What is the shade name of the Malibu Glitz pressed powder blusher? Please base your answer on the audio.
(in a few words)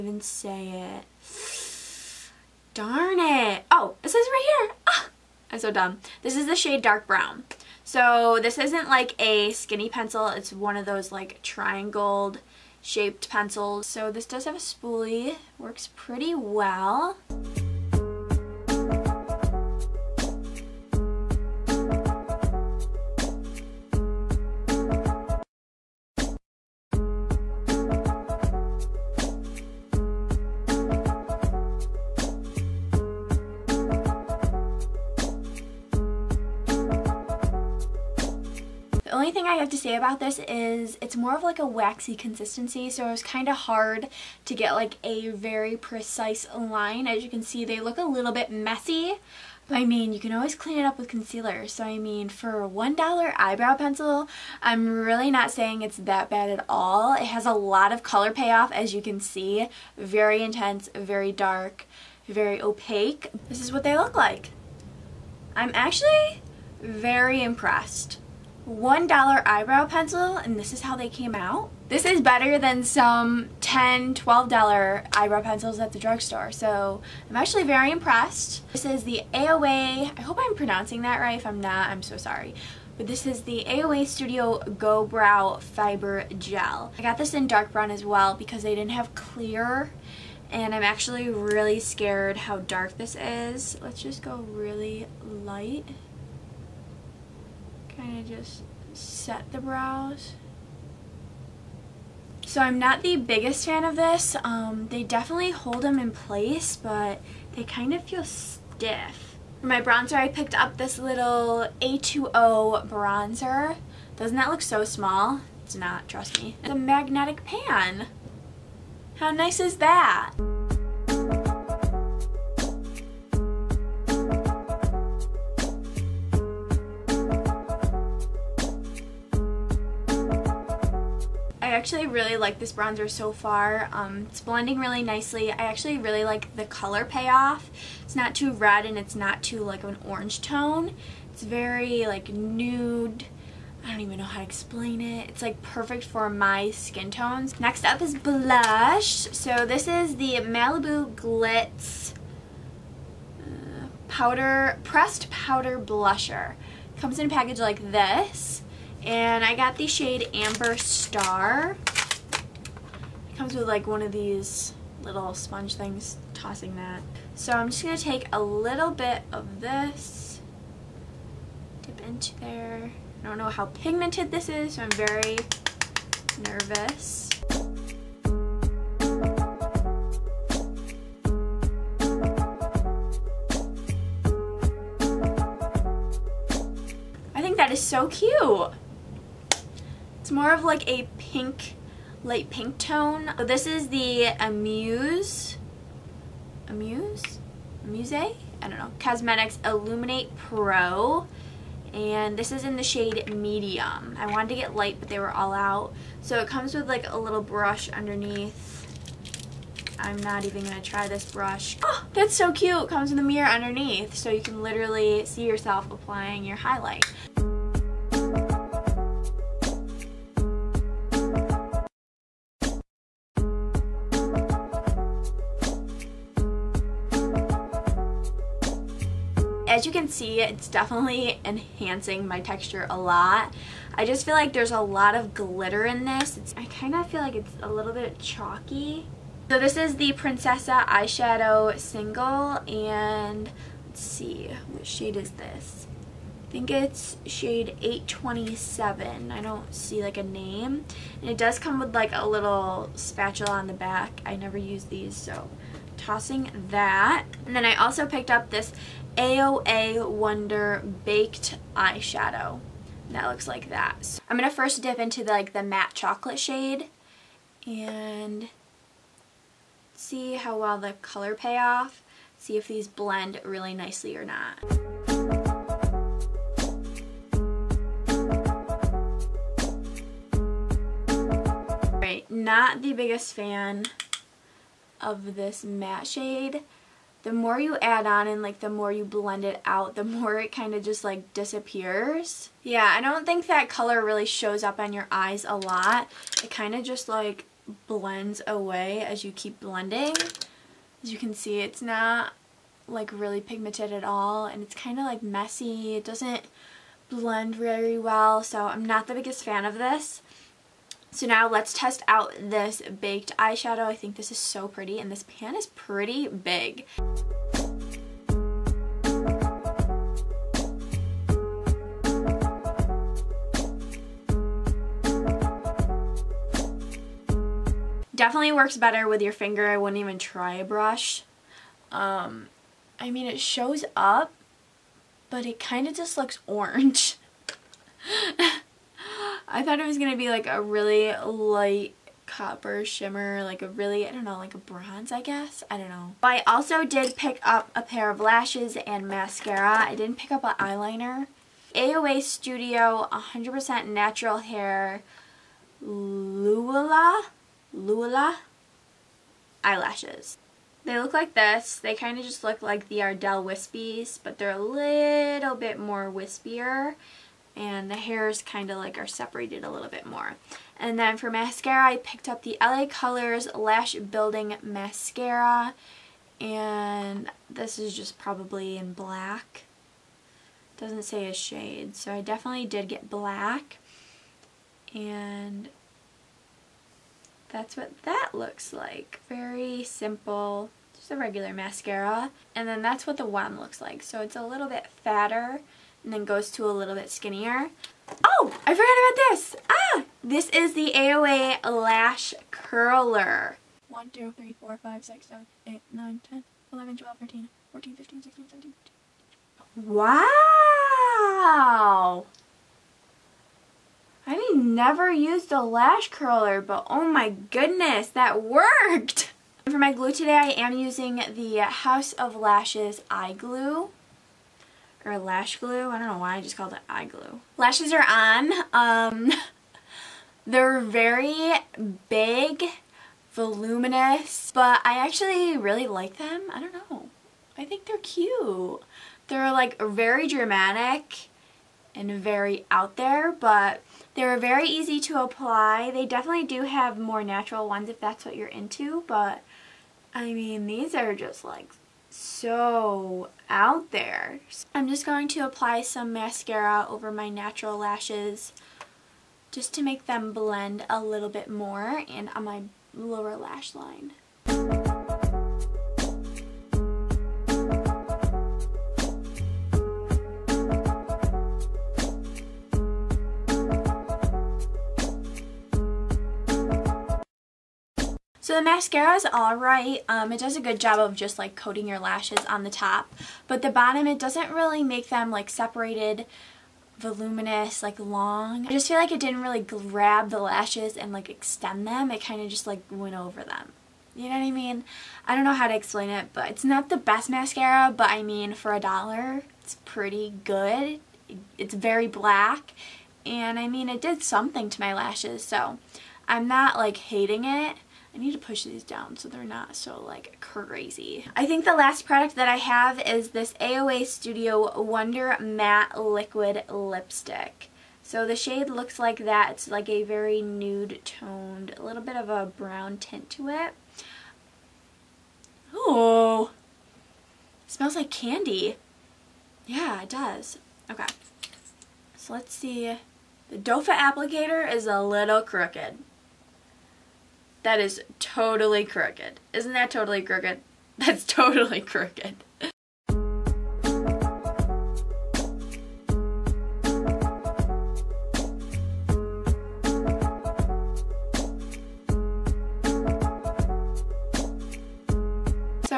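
Amber Star.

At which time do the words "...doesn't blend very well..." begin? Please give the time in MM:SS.
05:06.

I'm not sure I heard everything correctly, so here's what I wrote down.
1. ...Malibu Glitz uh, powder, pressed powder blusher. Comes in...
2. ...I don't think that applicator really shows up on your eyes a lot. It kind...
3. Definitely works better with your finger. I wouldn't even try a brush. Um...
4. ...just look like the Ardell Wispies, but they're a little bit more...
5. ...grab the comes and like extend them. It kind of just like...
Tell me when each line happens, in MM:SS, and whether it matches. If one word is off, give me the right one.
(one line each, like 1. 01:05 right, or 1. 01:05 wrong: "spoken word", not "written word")
1. 02:30 right
2. 04:52 wrong: "color", not "applicator"
3. 05:28 right
4. 06:02 right
5. 08:09 wrong: "lashes", not "comes".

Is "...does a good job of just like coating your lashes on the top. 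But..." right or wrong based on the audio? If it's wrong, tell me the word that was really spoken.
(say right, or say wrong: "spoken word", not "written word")
right.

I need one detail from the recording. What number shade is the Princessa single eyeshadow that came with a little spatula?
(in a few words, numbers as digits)
827.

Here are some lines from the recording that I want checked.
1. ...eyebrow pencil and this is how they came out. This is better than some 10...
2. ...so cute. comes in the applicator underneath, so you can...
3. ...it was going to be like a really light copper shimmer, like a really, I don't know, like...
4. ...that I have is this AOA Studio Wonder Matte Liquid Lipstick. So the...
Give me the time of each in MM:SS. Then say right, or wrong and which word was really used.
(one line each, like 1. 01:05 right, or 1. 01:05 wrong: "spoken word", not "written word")
1. 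01:09 right
2. 03:32 wrong: "mirror", not "applicator"
3. 05:39 right
4. 08:32 right.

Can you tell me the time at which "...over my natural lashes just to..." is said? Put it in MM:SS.
07:36.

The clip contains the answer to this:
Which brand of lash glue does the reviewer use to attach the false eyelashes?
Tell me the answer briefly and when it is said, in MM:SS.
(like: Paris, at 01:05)
House of Lashes, at 07:01.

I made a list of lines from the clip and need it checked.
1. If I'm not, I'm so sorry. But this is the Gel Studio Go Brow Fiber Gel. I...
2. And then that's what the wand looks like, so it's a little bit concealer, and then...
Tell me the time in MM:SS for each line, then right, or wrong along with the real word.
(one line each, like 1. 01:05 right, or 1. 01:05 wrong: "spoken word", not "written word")
1. 01:21 wrong: "AOA", not "Gel"
2. 06:32 wrong: "fatter", not "concealer".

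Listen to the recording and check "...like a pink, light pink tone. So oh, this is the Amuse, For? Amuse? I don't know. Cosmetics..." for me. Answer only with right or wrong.
wrong.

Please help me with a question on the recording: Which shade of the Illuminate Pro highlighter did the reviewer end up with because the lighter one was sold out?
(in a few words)
Medium.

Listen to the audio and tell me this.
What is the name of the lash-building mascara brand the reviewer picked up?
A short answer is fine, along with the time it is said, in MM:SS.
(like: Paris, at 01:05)
LA Colors, at 06:12.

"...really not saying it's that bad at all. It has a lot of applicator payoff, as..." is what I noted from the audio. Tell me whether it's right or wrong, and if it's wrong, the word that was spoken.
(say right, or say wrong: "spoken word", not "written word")
wrong: "color", not "applicator".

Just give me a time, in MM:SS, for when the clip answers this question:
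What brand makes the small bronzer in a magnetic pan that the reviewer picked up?
01:51.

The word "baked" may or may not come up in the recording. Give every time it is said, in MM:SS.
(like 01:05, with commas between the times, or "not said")
04:21, 05:12.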